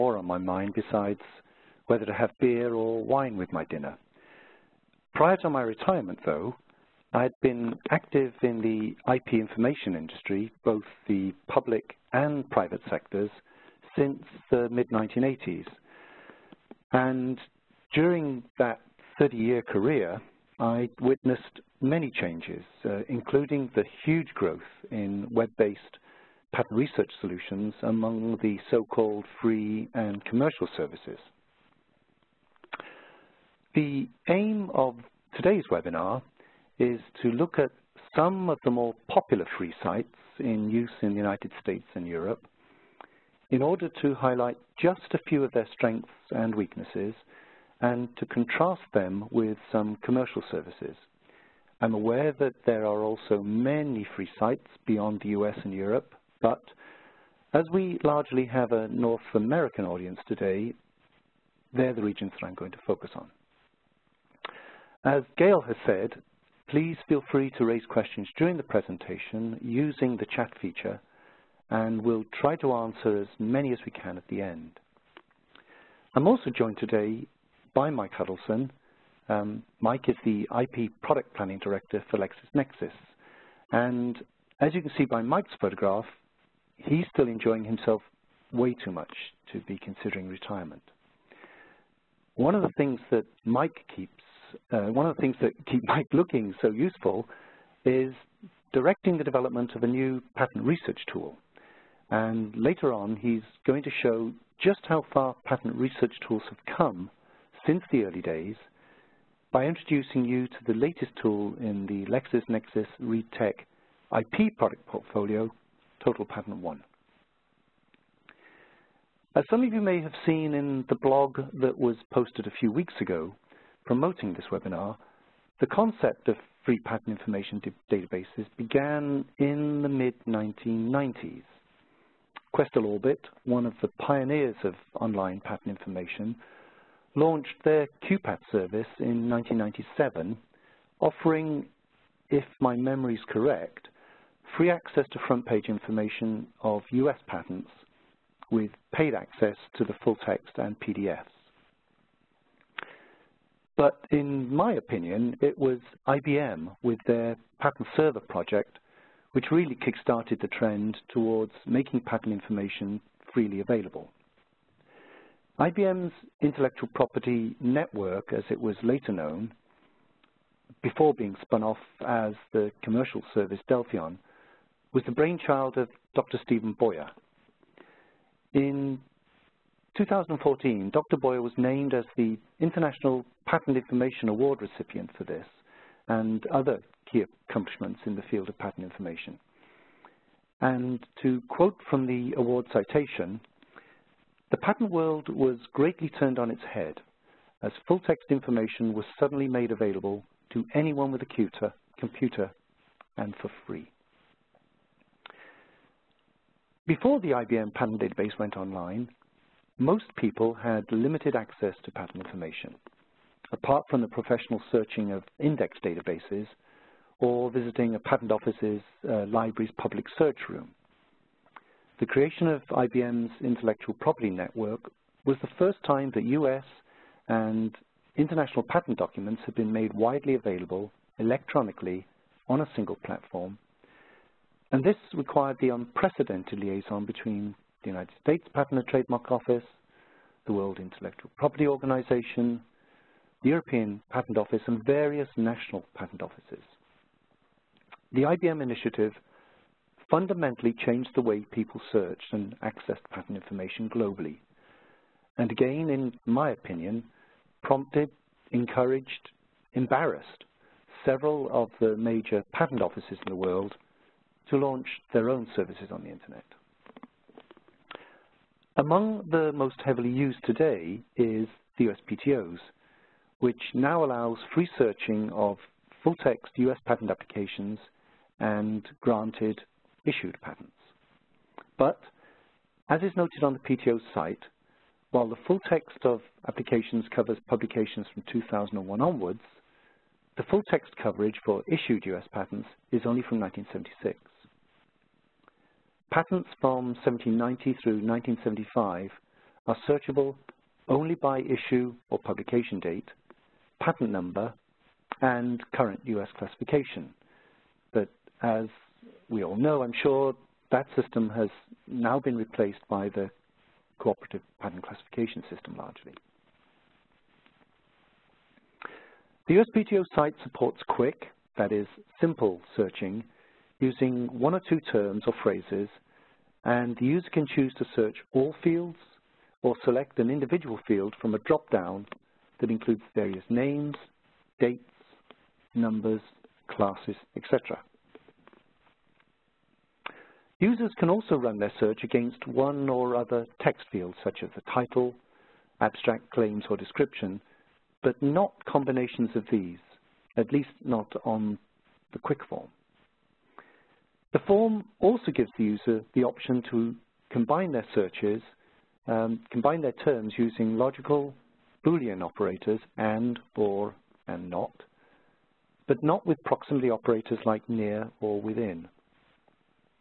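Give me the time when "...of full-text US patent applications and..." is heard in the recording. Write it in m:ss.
4:35.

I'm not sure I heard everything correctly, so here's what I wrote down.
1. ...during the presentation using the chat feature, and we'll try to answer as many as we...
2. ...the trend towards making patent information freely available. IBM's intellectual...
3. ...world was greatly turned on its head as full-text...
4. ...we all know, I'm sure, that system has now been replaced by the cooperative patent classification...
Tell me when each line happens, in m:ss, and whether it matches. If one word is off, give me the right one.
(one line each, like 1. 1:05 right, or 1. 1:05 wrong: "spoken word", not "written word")
1. 1:08 right
2. 2:40 right
3. 3:14 right
4. 5:09 right.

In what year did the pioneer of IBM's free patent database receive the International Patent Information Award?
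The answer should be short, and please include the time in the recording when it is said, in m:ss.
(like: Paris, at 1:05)
2014, at 2:59.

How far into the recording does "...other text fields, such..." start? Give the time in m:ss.
5:43.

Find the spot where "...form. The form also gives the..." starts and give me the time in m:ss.
5:52.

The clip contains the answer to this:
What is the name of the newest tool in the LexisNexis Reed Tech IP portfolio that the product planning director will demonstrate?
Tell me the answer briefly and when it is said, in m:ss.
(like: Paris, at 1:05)
TotalPatent One, at 1:56.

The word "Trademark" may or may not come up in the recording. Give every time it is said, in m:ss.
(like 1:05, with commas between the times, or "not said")
3:58.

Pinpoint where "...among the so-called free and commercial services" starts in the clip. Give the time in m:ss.
0:27.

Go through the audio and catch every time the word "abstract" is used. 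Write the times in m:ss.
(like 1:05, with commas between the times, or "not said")
5:45.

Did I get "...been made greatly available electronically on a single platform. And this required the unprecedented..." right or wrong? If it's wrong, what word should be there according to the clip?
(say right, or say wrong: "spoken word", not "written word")
wrong: "widely", not "greatly".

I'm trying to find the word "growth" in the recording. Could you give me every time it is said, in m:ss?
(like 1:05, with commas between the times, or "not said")
0:24.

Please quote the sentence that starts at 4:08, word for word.
The IBM initiative fundamentally changed the way people searched and accessed patent information globally.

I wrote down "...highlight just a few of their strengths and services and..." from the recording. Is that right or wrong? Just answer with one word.
wrong.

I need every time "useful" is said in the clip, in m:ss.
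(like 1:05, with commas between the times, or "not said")
1:36.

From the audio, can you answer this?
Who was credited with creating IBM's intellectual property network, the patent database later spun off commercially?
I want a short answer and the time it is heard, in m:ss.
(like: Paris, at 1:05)
Dr. Stephen Boyer, at 2:56.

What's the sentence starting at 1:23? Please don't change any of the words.
And as you can see by Mike's photograph, he's still enjoying himself way too much to be considering retirement.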